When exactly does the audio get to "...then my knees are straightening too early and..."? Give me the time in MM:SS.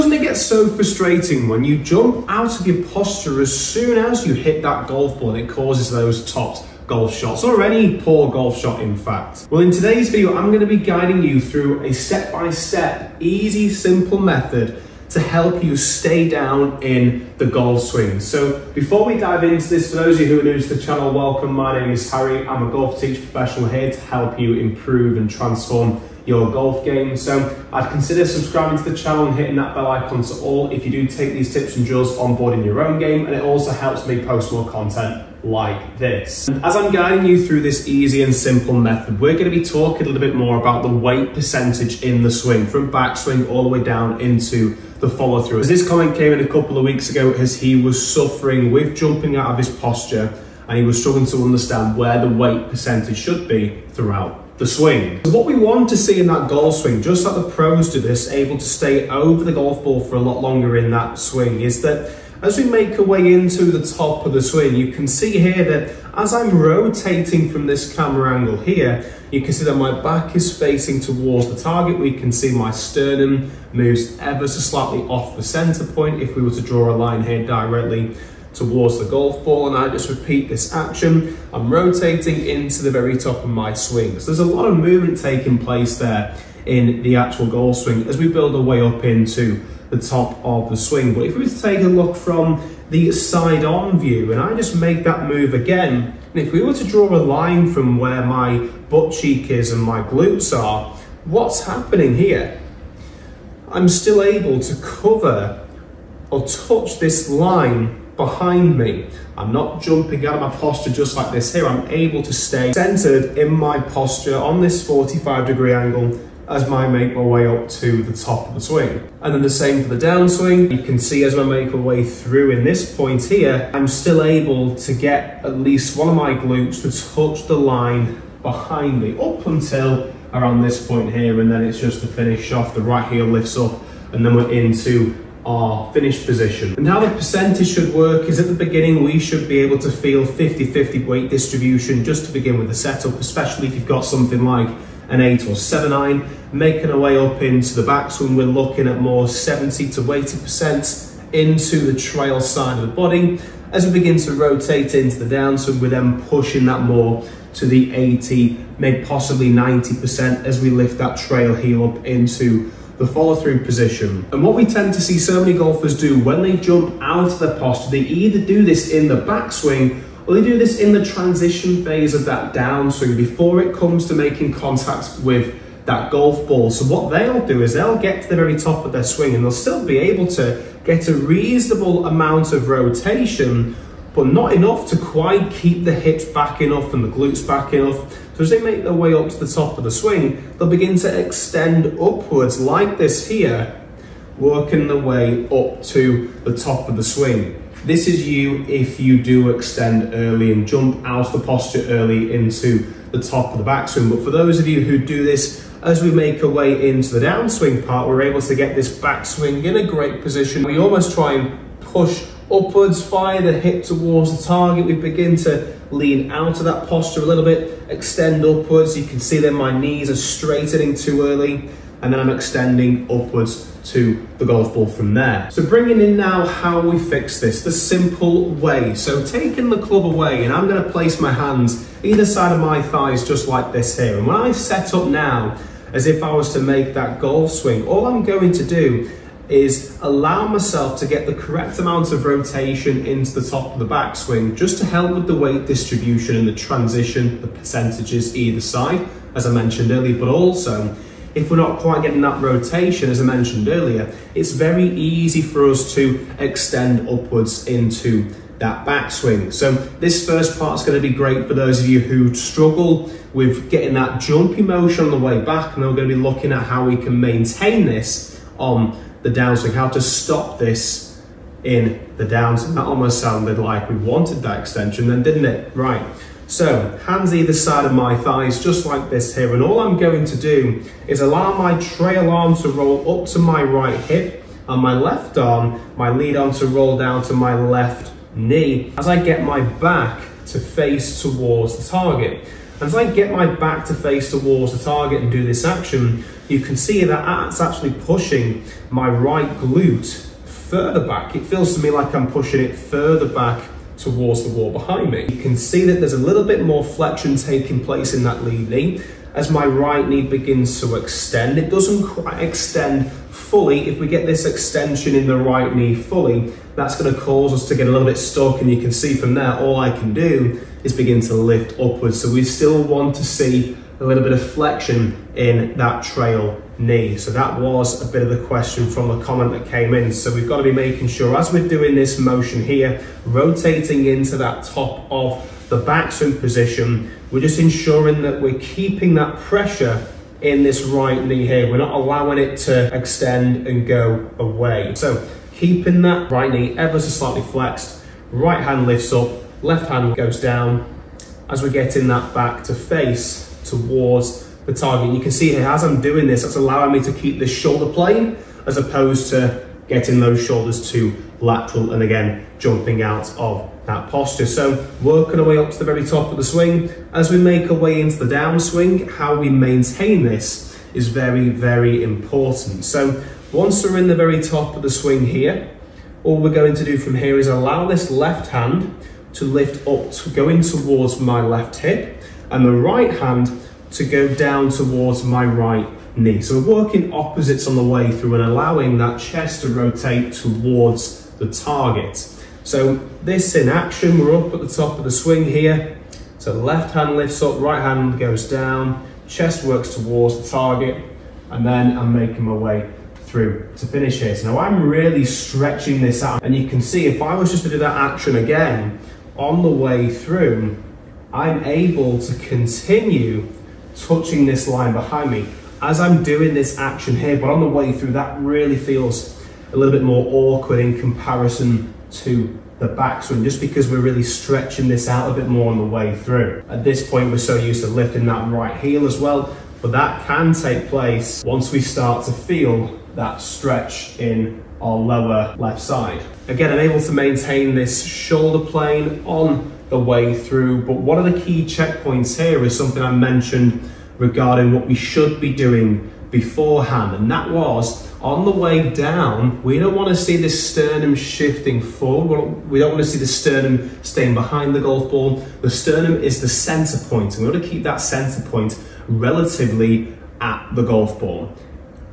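03:39.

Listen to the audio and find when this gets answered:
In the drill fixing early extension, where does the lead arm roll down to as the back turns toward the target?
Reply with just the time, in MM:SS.
04:47.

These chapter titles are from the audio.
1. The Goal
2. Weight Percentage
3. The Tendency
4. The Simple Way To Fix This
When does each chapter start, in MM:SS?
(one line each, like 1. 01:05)
1. 00:54
2. 02:16
3. 02:44
4. 03:44.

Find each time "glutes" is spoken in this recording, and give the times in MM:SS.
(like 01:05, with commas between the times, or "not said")
01:40, 02:06, 03:07, 04:59.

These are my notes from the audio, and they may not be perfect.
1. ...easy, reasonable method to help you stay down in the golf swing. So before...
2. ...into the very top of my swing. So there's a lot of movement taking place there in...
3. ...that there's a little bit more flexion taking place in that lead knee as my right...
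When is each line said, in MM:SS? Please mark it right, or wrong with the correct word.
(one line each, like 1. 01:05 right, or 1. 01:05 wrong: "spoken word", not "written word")
1. 00:13 wrong: "simple", not "reasonable"
2. 01:22 right
3. 05:05 right.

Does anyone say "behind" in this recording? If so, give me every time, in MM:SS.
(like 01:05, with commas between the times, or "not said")
01:48, 02:08, 05:04, 06:54, 07:34.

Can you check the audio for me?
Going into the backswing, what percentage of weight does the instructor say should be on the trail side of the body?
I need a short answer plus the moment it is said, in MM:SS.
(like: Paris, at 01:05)
70 to 80%, at 02:29.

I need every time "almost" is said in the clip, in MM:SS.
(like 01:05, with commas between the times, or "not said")
03:30, 04:32.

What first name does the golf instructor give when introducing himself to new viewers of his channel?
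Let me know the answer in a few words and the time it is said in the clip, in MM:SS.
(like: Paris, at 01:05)
Harry, at 00:22.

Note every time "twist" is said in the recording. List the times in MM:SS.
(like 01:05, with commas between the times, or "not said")
not said.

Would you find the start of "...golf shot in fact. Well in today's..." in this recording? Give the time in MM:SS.
00:08.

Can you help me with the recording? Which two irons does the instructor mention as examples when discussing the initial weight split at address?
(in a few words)
8 or 7 iron.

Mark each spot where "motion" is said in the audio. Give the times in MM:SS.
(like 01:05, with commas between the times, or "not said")
04:24, 05:32.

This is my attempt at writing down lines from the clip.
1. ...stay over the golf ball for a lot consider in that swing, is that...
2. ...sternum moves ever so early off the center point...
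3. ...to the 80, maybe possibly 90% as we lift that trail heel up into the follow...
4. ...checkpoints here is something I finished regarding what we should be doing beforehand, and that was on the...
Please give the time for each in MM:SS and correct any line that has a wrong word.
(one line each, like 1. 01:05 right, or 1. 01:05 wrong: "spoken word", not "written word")
1. 00:58 wrong: "longer", not "consider"
2. 01:12 wrong: "slightly", not "early"
3. 02:37 right
4. 07:21 wrong: "mentioned", not "finished".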